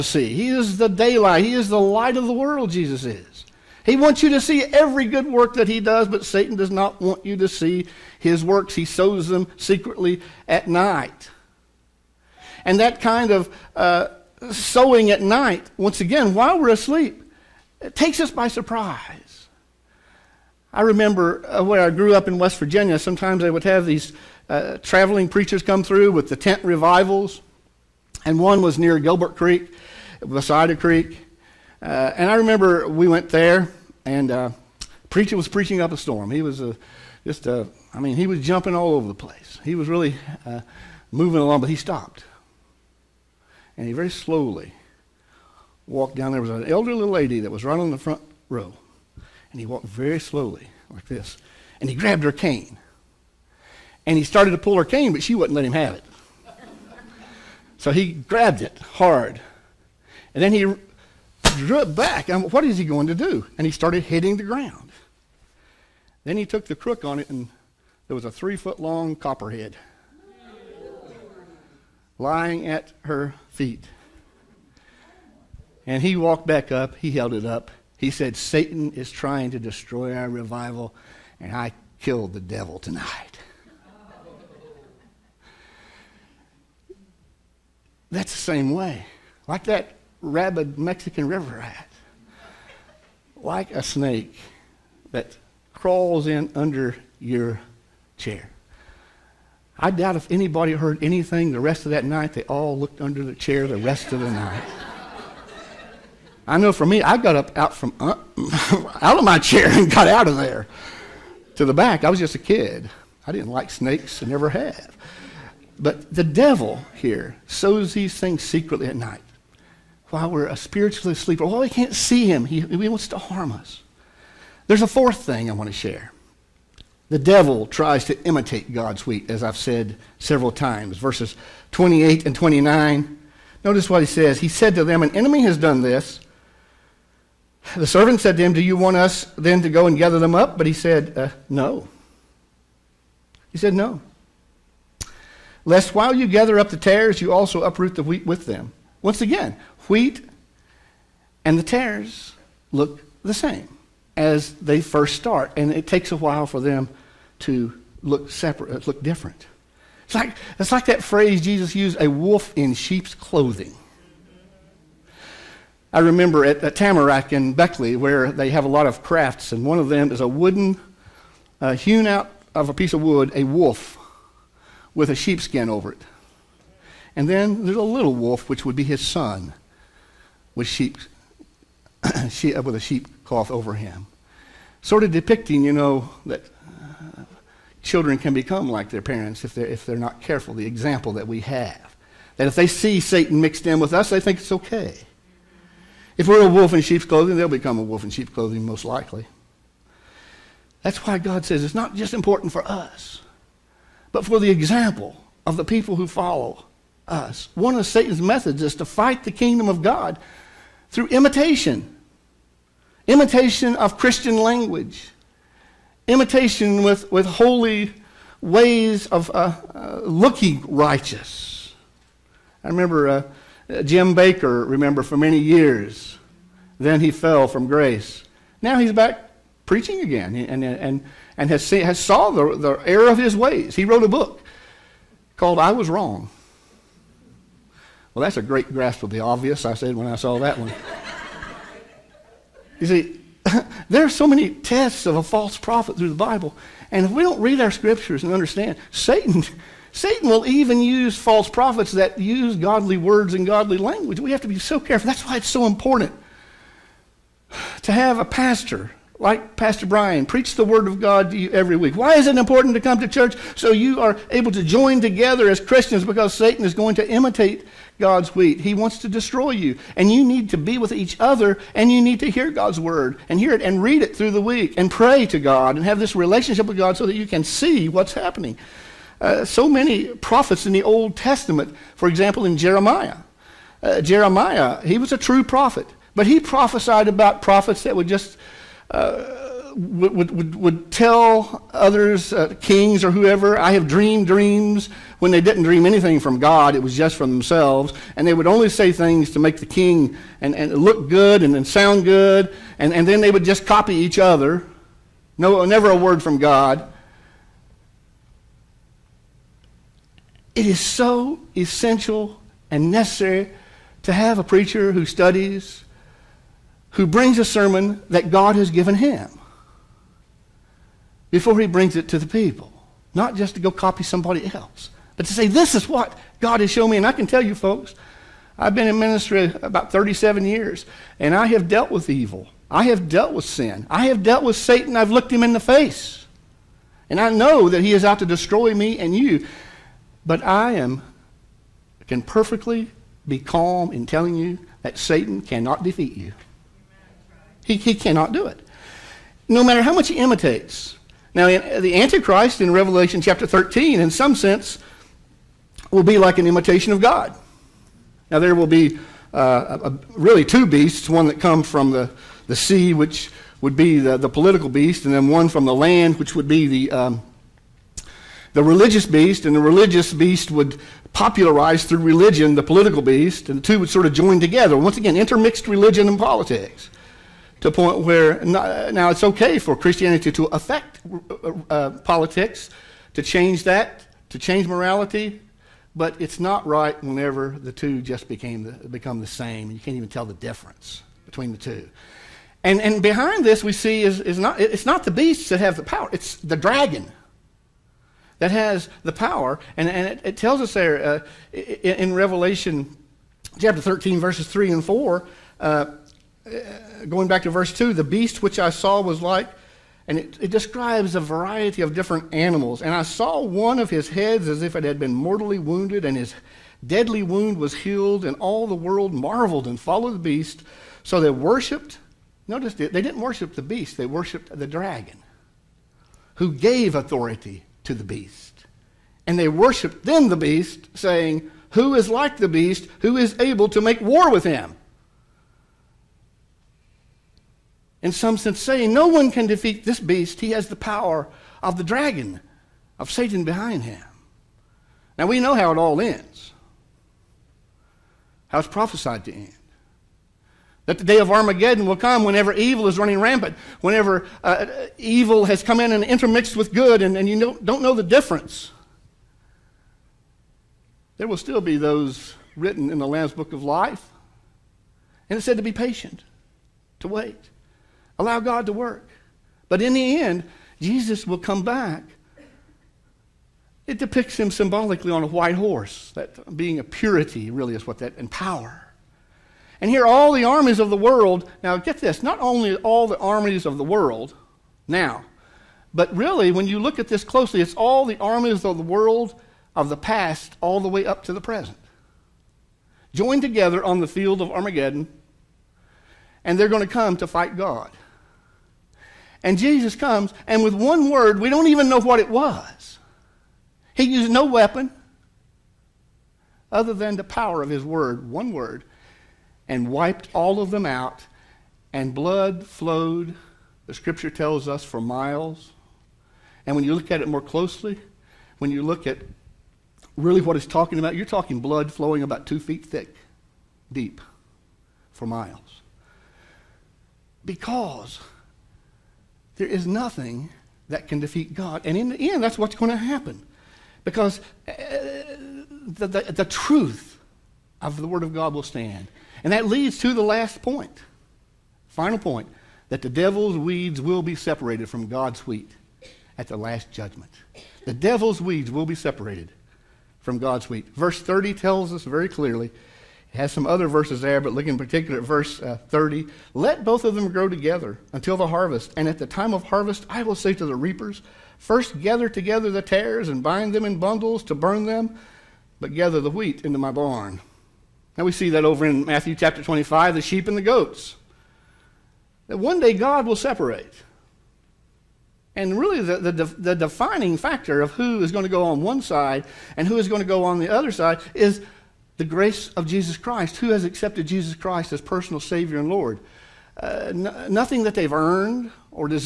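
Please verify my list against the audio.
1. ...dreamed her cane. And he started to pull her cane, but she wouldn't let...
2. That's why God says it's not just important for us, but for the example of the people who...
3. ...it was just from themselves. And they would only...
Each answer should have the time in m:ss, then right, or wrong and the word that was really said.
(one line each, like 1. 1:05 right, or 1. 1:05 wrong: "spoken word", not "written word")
1. 0:51 wrong: "grabbed", not "dreamed"
2. 3:20 right
3. 4:56 right.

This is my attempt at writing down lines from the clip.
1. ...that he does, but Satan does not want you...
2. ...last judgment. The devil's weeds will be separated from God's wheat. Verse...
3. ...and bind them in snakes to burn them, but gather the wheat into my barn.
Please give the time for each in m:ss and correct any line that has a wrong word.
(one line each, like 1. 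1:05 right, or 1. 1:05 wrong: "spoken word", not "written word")
1. 0:05 right
2. 9:06 right
3. 9:23 wrong: "bundles", not "snakes".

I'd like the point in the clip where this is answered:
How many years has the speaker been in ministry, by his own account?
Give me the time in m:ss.
5:29.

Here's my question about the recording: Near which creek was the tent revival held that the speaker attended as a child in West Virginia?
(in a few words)
Gilbert Creek.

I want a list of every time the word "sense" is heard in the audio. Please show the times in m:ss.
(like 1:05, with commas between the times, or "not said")
5:54, 7:18.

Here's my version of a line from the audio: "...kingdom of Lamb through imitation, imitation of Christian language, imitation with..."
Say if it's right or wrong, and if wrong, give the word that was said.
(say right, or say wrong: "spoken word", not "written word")
wrong: "God", not "Lamb".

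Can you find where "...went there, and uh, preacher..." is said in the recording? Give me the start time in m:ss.
0:33.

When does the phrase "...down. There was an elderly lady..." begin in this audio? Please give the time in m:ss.
0:46.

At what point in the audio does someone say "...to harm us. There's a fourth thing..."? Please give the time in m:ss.
2:03.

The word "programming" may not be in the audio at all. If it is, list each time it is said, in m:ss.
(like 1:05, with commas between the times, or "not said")
not said.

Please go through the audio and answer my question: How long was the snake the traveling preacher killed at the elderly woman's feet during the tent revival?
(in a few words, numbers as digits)
3 foot.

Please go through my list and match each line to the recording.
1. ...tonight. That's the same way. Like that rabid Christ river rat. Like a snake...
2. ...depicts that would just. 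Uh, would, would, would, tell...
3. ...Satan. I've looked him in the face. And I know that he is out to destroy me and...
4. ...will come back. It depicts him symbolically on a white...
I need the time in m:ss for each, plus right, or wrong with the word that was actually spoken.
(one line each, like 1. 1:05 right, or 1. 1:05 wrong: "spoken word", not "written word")
1. 1:22 wrong: "Mexican", not "Christ"
2. 4:47 wrong: "prophets", not "depicts"
3. 5:34 right
4. 7:51 right.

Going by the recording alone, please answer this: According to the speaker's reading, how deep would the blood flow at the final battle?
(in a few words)
2 feet.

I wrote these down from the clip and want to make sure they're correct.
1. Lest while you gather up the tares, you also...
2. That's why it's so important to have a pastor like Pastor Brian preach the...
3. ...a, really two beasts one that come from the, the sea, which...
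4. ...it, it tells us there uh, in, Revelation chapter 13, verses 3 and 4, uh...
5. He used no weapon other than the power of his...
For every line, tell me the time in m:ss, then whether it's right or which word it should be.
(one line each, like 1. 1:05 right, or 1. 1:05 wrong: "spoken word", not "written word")
1. 2:25 right
2. 4:15 right
3. 5:59 right
4. 6:40 right
5. 8:23 right.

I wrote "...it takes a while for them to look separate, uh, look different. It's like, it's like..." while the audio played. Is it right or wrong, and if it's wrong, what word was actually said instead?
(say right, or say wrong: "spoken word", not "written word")
right.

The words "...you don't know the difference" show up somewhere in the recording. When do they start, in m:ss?
7:37.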